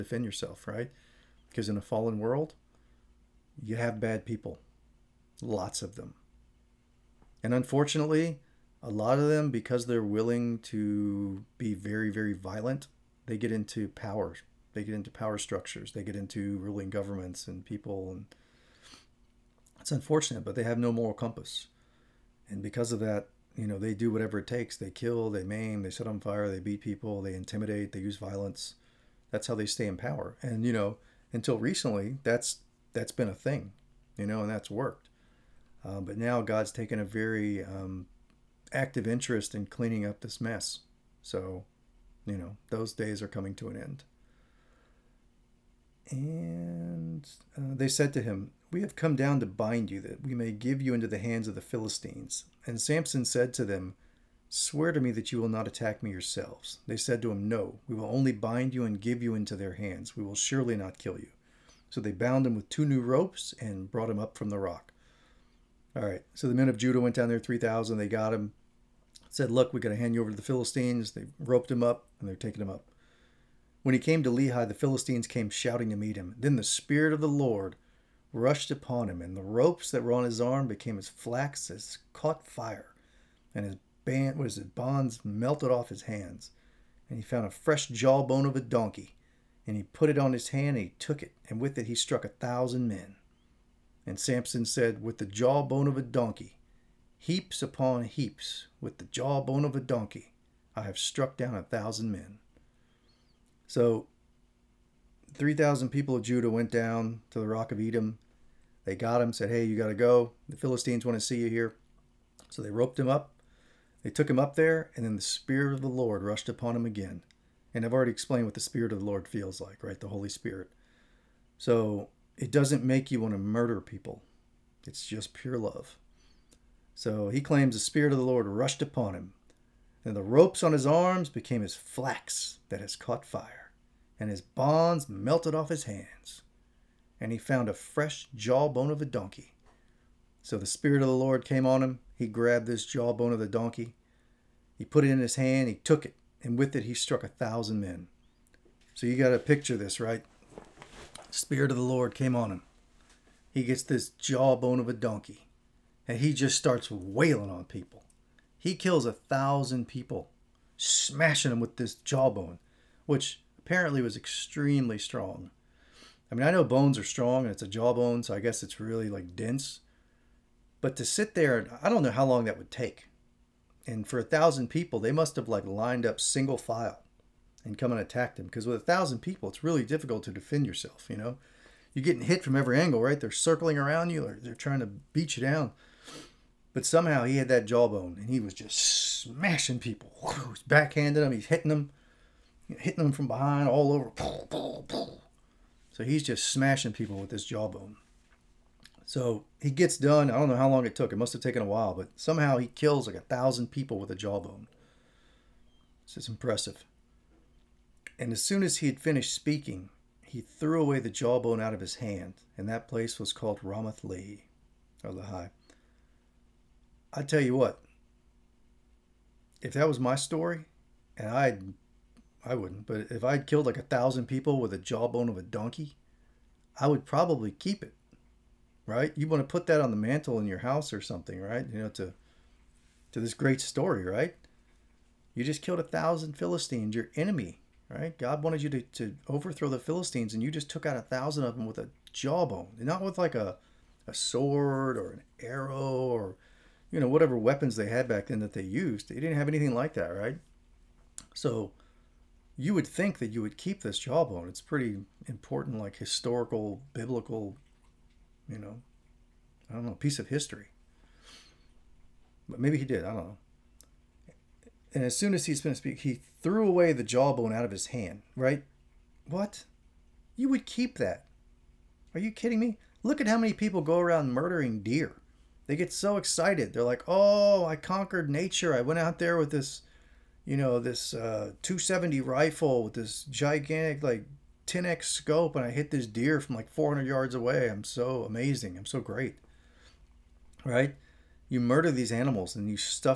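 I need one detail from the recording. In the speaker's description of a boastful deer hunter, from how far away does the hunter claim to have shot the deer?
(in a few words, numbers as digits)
400 yards.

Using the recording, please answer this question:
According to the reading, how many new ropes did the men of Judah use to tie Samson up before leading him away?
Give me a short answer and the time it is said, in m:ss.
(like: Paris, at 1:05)
2, at 1:02.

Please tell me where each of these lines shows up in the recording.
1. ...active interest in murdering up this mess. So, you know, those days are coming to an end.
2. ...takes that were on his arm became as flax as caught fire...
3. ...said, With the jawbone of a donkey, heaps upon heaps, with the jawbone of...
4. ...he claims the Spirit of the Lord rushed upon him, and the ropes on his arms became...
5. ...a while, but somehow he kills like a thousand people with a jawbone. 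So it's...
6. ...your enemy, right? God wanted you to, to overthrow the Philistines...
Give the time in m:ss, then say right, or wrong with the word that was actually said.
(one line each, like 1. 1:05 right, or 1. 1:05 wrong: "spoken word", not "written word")
1. 0:38 wrong: "cleaning", not "murdering"
2. 1:19 wrong: "ropes", not "takes"
3. 1:34 right
4. 2:07 right
5. 3:21 right
6. 3:56 right.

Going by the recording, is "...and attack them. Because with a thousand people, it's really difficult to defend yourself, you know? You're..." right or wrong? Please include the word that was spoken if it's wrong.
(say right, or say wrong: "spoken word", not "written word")
right.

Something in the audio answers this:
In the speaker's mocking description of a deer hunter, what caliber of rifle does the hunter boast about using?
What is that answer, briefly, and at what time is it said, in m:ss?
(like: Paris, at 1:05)
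270, at 4:41.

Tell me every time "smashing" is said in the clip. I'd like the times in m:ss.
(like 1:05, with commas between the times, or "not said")
2:40, 3:08, 3:16.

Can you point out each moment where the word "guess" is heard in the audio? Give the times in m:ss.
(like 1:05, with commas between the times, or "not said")
2:48.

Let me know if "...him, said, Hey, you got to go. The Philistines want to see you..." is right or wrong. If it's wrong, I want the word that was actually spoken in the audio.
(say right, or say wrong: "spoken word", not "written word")
right.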